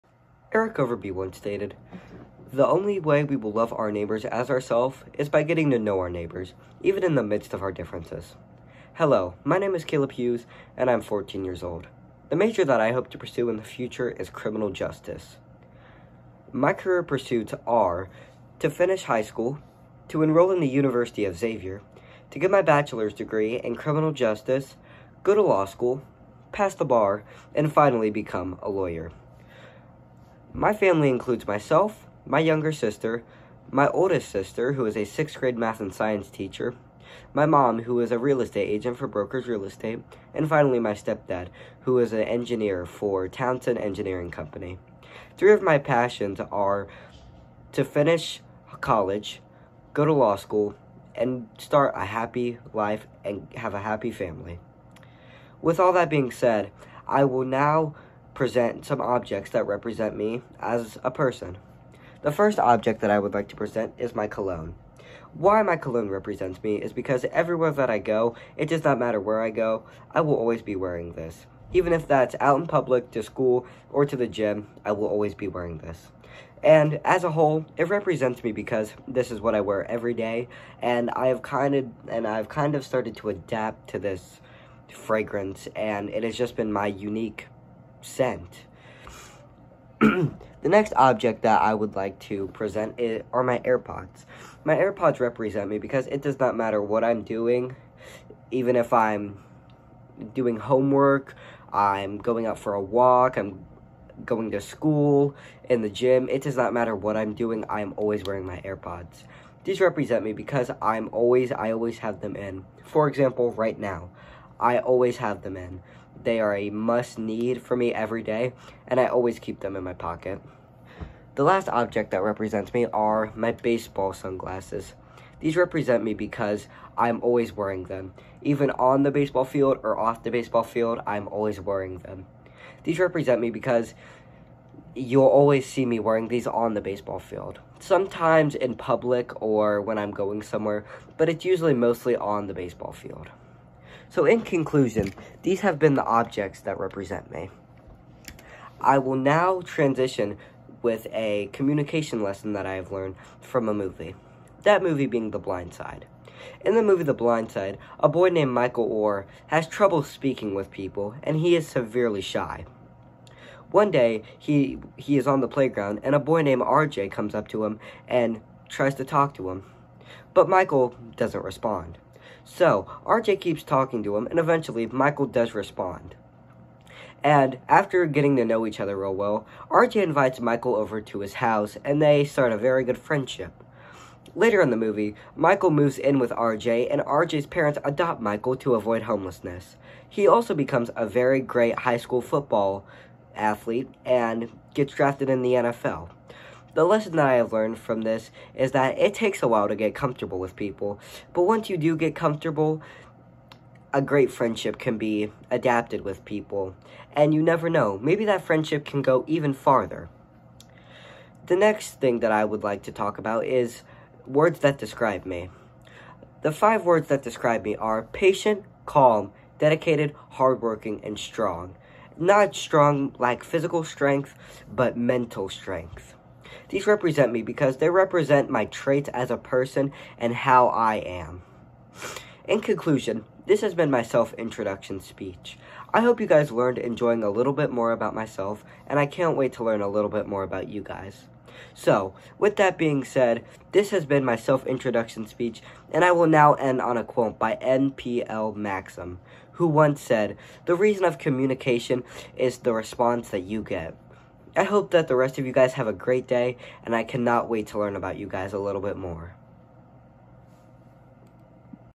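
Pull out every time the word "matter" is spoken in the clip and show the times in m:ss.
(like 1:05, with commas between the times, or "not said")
1:08, 1:36, 1:46.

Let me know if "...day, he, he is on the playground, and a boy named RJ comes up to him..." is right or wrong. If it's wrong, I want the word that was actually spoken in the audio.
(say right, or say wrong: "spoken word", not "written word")
right.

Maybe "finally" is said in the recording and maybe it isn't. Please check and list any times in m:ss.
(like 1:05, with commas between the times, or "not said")
0:27, 0:40.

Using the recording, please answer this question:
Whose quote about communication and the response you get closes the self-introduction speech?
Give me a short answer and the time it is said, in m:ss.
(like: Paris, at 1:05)
N.P.L. Maxim, at 4:07.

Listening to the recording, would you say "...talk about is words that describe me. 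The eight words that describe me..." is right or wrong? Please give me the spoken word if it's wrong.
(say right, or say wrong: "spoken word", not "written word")
wrong: "five", not "eight".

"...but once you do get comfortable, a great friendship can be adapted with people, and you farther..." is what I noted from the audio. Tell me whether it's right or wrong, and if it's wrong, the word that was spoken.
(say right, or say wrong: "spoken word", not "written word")
wrong: "never", not "farther".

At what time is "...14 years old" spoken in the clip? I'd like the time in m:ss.
0:10.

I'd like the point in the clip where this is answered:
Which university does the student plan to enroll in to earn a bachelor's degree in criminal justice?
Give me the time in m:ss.
0:20.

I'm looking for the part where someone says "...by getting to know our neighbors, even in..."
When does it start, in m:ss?
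0:05.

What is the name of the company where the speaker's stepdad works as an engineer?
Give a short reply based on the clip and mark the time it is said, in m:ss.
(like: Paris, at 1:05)
Townsend Engineering Company, at 0:43.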